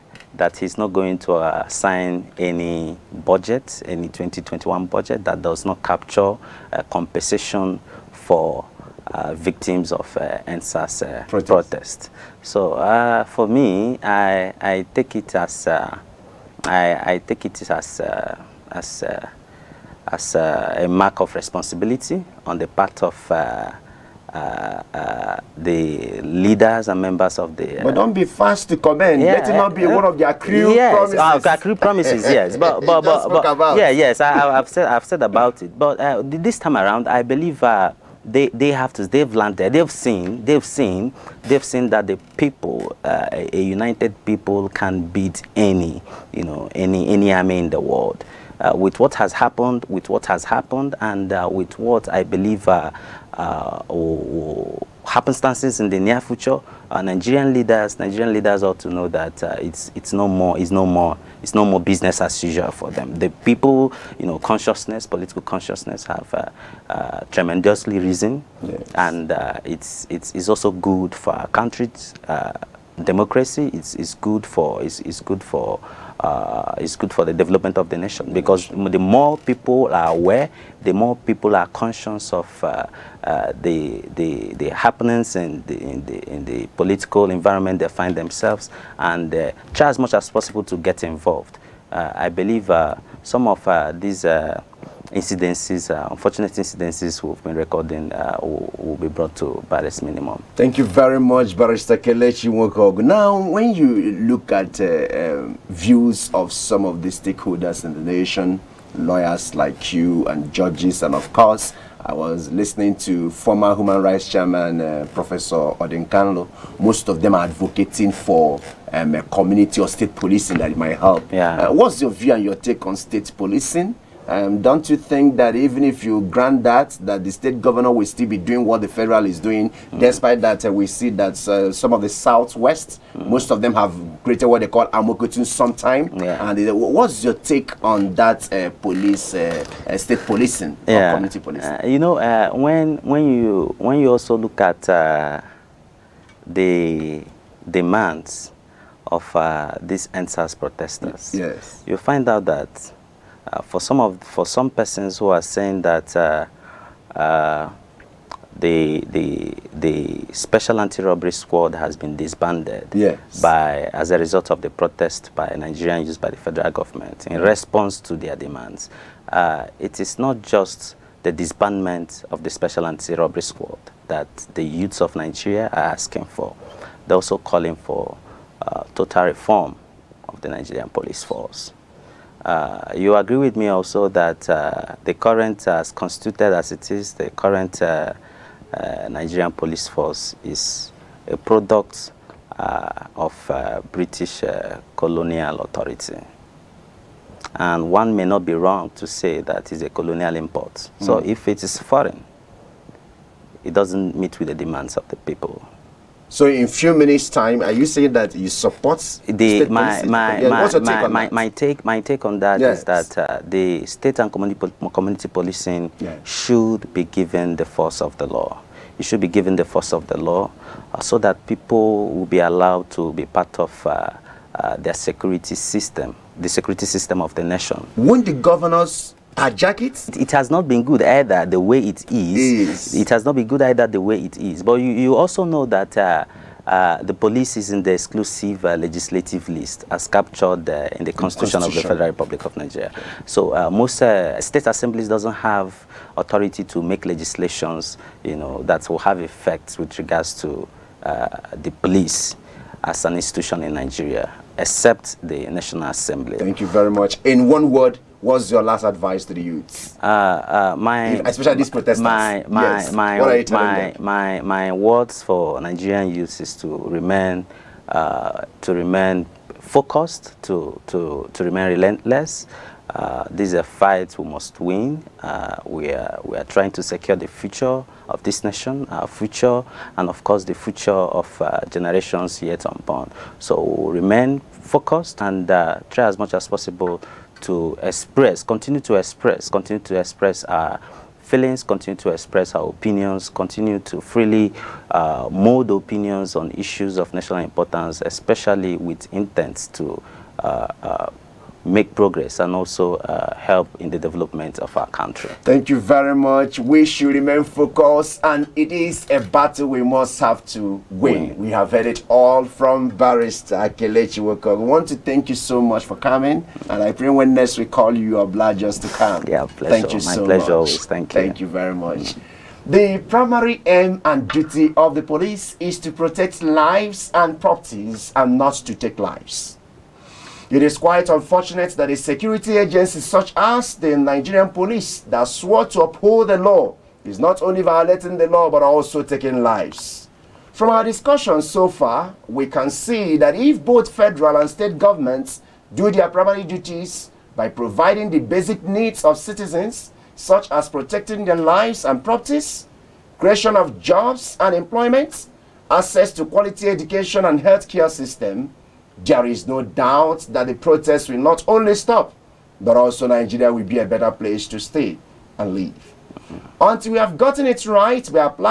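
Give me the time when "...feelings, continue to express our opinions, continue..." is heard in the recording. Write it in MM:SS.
04:51.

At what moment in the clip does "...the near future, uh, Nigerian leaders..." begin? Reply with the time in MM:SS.
00:55.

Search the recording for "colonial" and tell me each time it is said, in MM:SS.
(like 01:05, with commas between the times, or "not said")
03:14, 03:19.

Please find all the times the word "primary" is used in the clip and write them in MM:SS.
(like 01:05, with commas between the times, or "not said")
05:23, 05:46.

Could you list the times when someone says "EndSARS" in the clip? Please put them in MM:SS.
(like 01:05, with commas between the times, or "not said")
00:10, 02:30.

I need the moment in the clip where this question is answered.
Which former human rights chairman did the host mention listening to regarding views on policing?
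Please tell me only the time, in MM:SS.
01:55.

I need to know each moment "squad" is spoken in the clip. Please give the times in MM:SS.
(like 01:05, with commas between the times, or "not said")
02:41, 02:53.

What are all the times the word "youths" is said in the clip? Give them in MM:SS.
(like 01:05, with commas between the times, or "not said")
02:54, 04:19, 04:26.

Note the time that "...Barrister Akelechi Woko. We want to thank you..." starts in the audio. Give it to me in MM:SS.
05:12.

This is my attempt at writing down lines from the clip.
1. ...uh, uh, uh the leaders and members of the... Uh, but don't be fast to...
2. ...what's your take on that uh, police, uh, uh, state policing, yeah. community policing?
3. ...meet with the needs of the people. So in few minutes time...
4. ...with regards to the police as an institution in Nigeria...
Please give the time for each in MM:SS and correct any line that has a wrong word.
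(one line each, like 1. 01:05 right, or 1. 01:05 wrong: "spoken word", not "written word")
1. 00:23 right
2. 02:16 right
3. 03:24 wrong: "demands", not "needs"
4. 04:09 right.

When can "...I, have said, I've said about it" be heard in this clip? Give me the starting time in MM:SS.
00:34.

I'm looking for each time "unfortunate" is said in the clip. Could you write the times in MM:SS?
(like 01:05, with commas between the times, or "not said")
01:36, 05:31.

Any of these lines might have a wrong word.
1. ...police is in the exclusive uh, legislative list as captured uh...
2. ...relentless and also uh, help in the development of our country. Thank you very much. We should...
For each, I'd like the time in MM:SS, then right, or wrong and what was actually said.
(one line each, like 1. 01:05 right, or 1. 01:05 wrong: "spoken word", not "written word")
1. 03:57 right
2. 05:01 wrong: "progress", not "relentless".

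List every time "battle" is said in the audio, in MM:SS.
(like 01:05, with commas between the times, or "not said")
05:09.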